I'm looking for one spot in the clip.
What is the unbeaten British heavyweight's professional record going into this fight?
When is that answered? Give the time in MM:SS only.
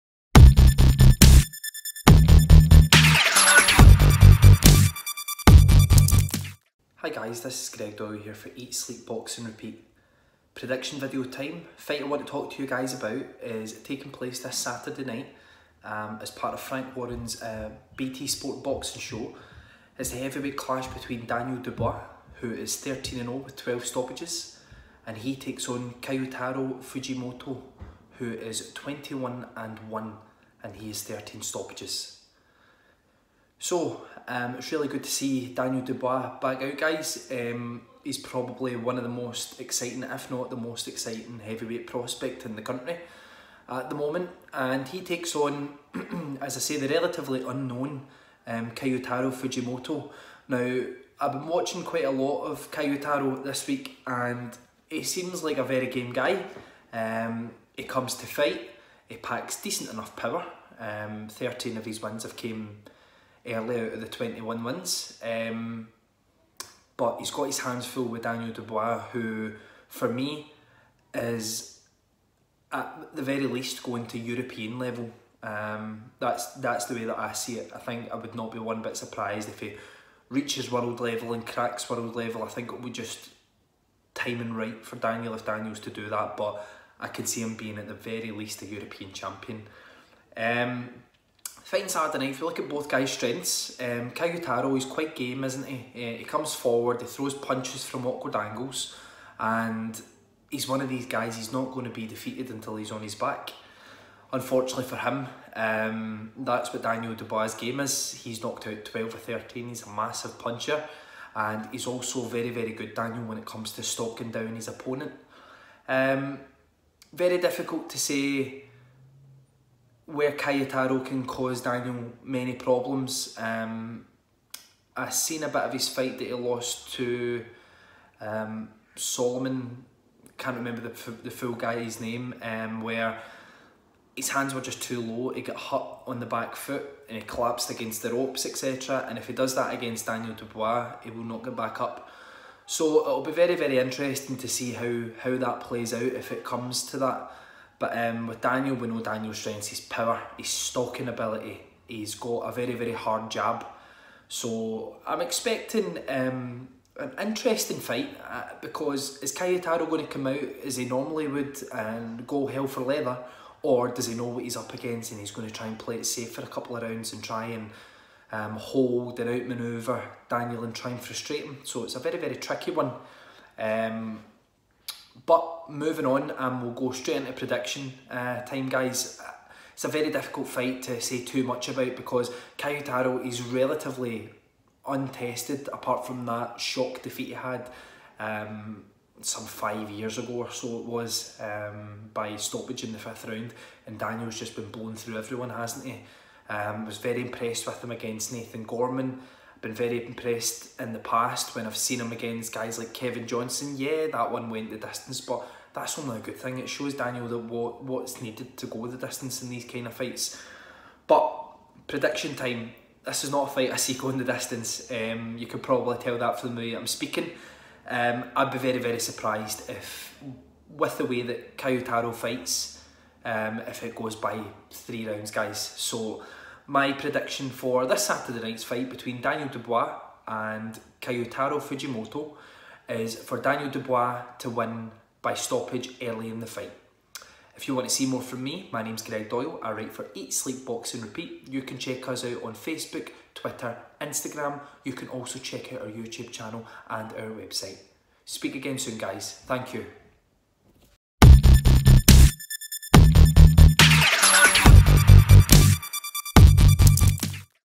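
00:22.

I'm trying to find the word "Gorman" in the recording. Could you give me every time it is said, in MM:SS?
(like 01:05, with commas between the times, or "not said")
03:18.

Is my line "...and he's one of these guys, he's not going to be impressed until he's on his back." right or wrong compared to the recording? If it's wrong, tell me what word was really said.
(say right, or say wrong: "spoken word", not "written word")
wrong: "defeated", not "impressed".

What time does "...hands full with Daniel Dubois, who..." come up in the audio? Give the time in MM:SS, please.
01:07.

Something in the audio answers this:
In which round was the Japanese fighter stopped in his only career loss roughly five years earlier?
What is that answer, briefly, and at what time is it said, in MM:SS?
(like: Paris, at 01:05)
fifth, at 03:12.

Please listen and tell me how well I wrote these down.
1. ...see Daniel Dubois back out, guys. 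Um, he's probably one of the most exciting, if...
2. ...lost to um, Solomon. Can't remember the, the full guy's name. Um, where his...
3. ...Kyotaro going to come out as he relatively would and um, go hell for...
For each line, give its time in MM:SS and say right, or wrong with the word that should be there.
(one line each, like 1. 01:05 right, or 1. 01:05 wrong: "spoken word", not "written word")
1. 00:35 right
2. 02:06 right
3. 02:39 wrong: "normally", not "relatively".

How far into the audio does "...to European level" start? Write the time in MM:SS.
01:14.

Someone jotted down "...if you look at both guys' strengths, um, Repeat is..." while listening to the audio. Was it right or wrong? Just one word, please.
wrong.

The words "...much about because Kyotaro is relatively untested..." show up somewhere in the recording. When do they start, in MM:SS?
03:01.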